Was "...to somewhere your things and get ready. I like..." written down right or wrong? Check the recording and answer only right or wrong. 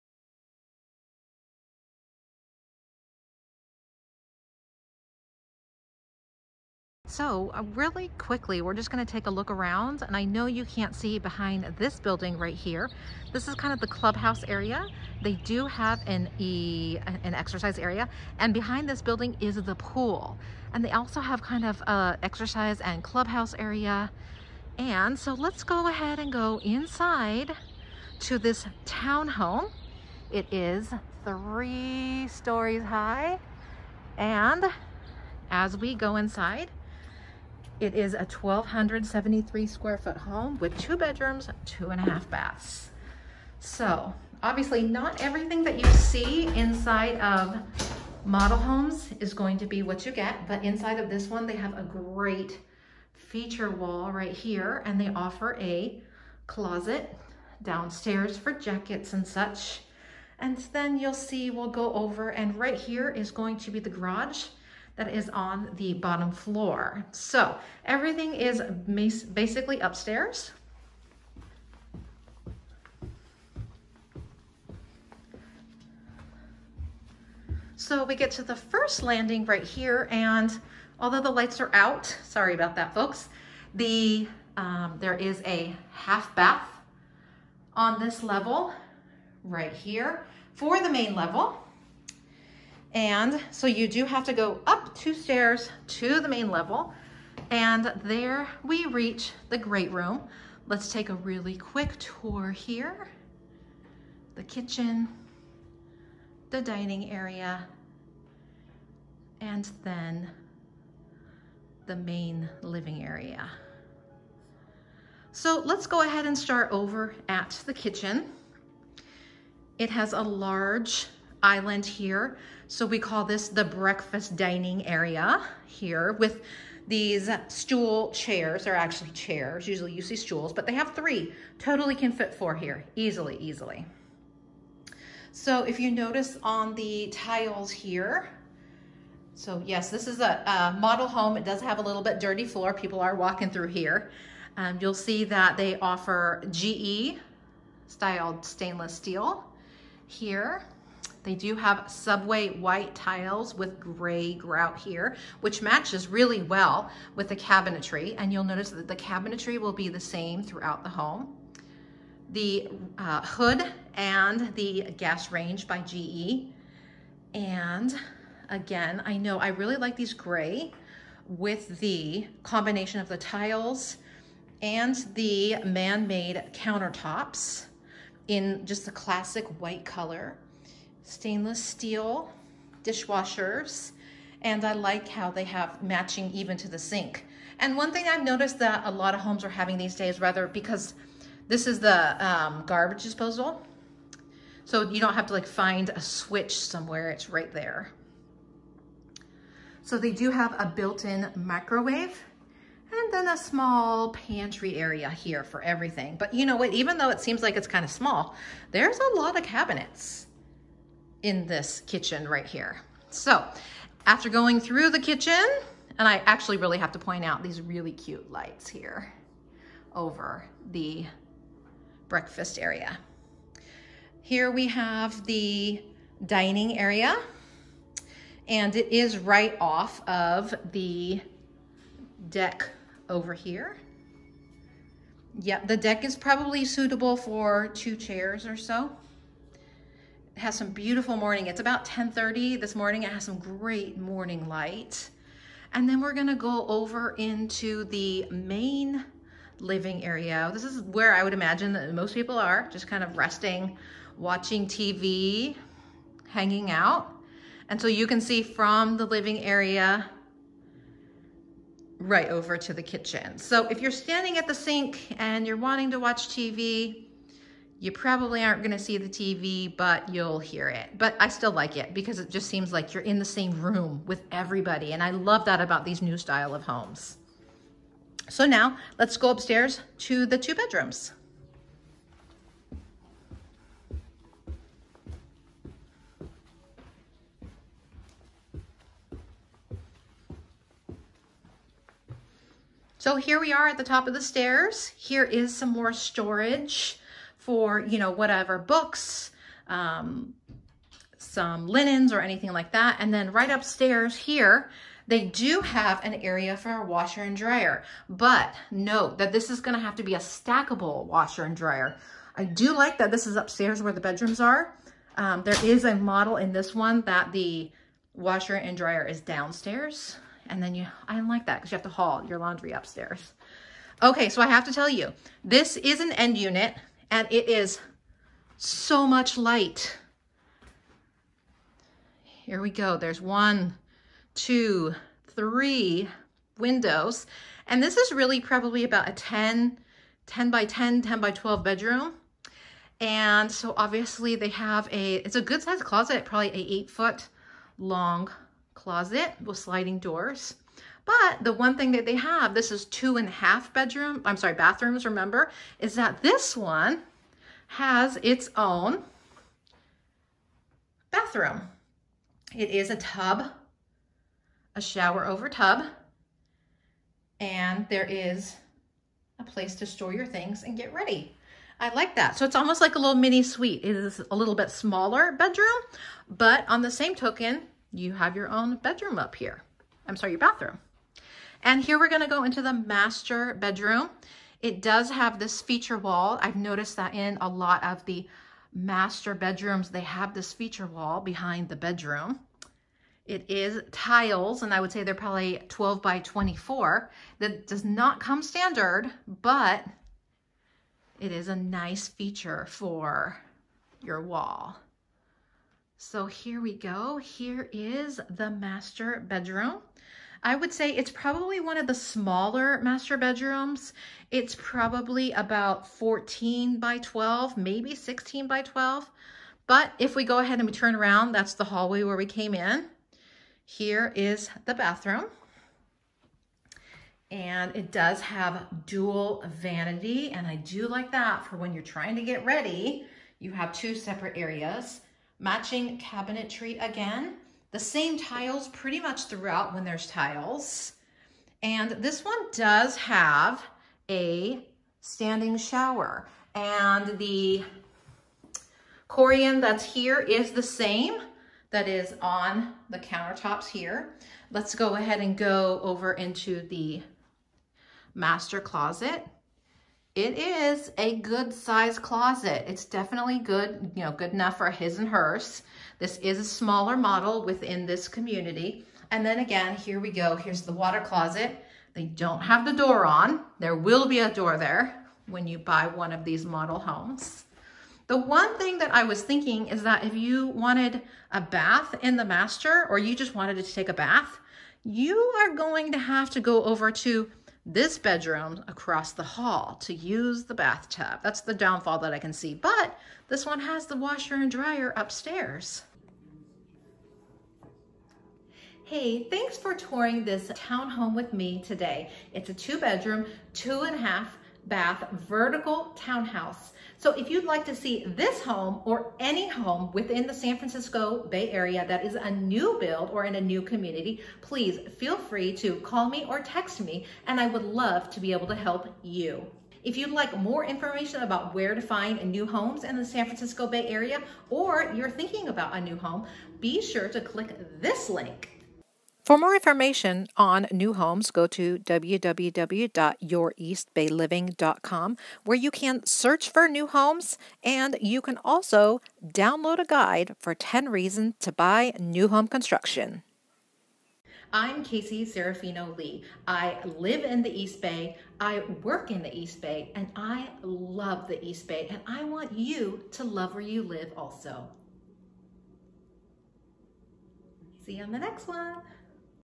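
wrong.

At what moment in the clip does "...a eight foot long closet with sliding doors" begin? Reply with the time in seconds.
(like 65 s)
346 s.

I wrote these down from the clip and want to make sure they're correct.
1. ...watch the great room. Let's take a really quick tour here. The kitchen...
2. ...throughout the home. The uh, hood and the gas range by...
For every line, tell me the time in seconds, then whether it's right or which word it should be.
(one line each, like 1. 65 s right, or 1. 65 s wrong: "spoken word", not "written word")
1. 98 s wrong: "reach", not "watch"
2. 160 s right.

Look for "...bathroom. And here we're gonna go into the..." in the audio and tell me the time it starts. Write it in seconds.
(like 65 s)
380 s.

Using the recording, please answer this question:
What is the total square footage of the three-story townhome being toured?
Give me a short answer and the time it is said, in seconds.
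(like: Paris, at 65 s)
1,273, at 38 s.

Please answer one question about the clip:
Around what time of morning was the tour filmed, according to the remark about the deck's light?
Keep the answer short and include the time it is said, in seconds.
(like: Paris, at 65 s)
10:30, at 241 s.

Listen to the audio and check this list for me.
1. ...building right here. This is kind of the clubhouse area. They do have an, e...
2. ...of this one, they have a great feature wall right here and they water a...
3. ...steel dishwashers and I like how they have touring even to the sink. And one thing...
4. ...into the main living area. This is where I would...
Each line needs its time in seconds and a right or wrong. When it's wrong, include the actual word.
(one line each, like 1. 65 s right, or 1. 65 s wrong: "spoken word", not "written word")
1. 11 s right
2. 50 s wrong: "offer", not "water"
3. 181 s wrong: "matching", not "touring"
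4. 247 s right.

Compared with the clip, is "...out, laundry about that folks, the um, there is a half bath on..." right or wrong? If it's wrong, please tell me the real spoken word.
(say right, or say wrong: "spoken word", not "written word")
wrong: "sorry", not "laundry".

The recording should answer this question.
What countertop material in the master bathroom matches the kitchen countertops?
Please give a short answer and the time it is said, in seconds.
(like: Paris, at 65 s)
Corian, at 449 s.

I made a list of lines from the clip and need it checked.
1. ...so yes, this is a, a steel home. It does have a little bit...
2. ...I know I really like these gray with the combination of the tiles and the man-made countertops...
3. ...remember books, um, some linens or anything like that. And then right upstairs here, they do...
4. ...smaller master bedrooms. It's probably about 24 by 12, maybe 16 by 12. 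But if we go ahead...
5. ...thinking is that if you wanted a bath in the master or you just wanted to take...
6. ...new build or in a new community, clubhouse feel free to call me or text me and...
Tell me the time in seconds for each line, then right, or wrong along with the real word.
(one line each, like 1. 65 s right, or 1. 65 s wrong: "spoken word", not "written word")
1. 139 s wrong: "model", not "steel"
2. 169 s right
3. 298 s wrong: "whatever", not "remember"
4. 411 s wrong: "14", not "24"
5. 479 s right
6. 512 s wrong: "please", not "clubhouse".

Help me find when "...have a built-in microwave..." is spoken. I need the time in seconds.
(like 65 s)
200 s.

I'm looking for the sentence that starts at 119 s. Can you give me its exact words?
It has a large island here.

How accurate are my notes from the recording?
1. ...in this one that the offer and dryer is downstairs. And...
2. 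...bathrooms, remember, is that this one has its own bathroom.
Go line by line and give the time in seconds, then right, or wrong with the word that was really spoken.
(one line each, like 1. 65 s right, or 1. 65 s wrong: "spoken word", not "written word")
1. 316 s wrong: "washer", not "offer"
2. 354 s right.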